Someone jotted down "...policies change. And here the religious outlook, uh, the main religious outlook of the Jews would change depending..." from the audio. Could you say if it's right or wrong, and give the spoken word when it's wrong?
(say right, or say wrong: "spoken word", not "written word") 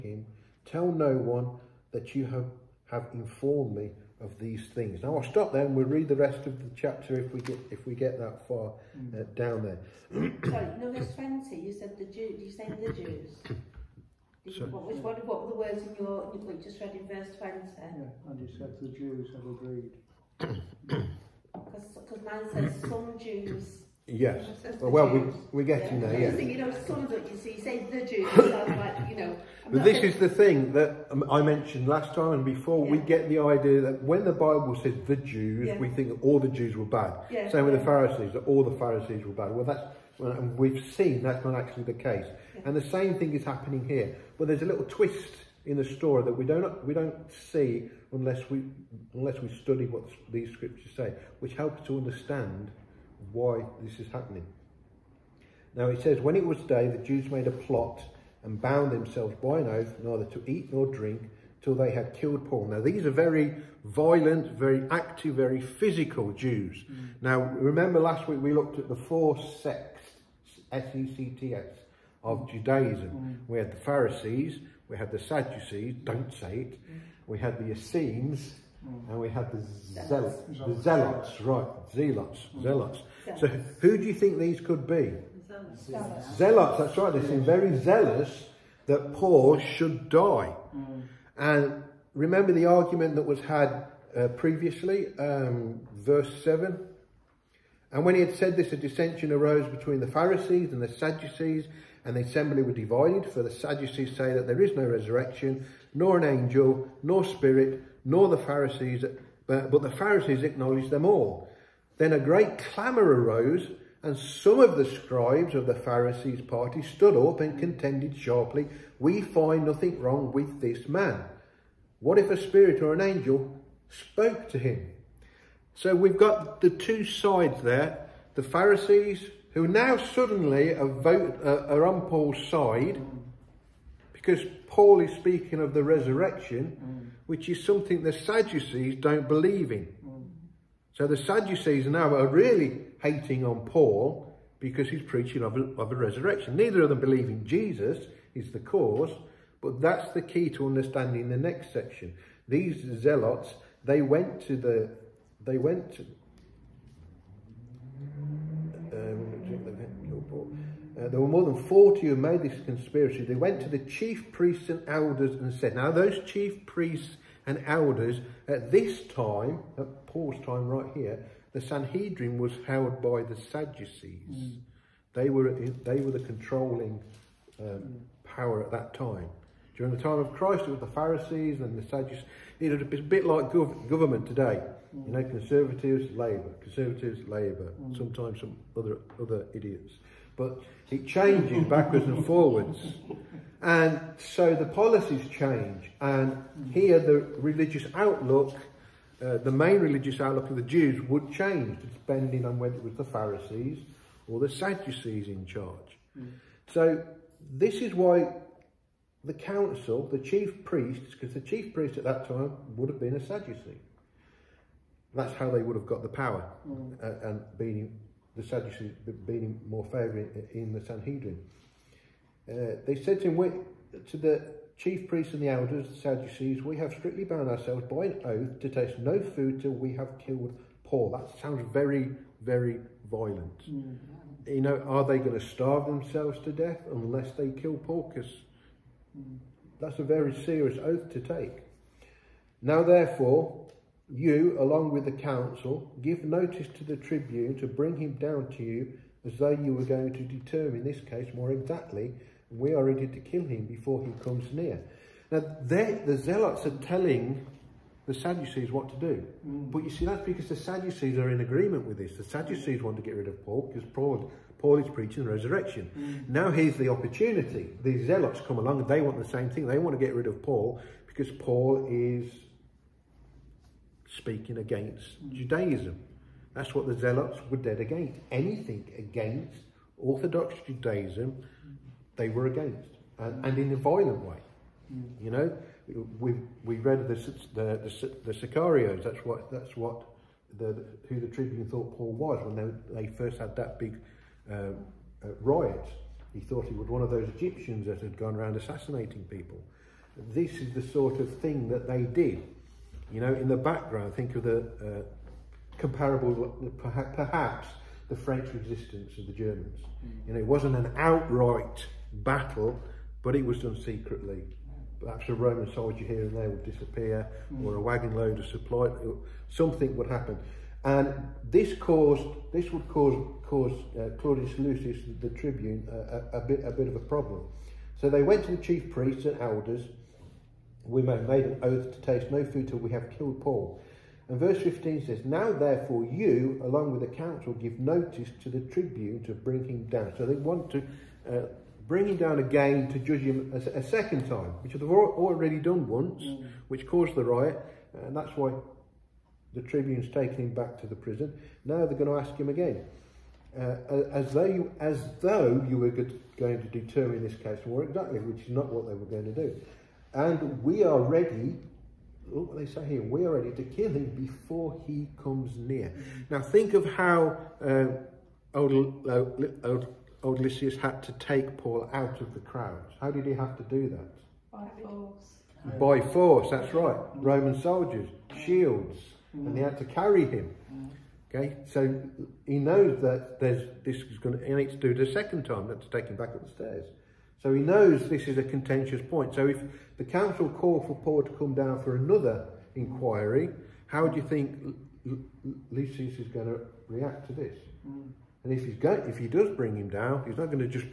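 right.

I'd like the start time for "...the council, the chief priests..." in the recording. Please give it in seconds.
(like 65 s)
209 s.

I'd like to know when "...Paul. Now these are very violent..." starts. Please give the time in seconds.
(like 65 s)
62 s.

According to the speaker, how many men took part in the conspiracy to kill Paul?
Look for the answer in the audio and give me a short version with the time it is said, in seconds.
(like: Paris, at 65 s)
more than 40, at 161 s.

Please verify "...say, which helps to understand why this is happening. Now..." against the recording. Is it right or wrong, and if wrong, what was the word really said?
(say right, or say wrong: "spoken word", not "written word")
right.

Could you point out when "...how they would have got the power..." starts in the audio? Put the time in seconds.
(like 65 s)
215 s.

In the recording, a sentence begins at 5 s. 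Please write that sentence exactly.
Now I'll stop there and we'll read the rest of the chapter if we get if we get that far uh, mm.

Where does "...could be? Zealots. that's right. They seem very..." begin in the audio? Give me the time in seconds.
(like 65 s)
84 s.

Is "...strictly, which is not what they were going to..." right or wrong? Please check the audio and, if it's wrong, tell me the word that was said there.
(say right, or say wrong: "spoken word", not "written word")
wrong: "exactly", not "strictly".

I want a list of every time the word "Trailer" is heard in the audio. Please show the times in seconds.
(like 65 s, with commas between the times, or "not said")
not said.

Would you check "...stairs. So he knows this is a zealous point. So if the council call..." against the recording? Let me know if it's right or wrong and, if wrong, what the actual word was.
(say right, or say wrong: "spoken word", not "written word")
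wrong: "contentious", not "zealous".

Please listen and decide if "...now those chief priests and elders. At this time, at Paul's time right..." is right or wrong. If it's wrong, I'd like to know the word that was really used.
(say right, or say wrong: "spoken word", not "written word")
right.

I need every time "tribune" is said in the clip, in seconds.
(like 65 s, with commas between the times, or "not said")
246 s, 291 s, 325 s, 338 s, 349 s.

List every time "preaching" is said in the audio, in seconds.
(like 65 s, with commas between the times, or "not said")
145 s, 264 s.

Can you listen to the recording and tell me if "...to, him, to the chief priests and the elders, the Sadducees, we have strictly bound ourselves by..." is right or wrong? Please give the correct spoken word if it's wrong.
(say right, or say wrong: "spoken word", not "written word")
right.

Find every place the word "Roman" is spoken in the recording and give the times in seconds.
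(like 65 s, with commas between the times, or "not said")
315 s, 377 s.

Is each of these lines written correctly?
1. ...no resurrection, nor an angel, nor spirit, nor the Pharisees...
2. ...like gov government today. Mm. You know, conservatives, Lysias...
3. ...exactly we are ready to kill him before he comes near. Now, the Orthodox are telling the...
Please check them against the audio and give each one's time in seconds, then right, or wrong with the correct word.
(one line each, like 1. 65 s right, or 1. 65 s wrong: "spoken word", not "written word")
1. 104 s right
2. 183 s wrong: "Labour", not "Lysias"
3. 251 s wrong: "Zealots", not "Orthodox".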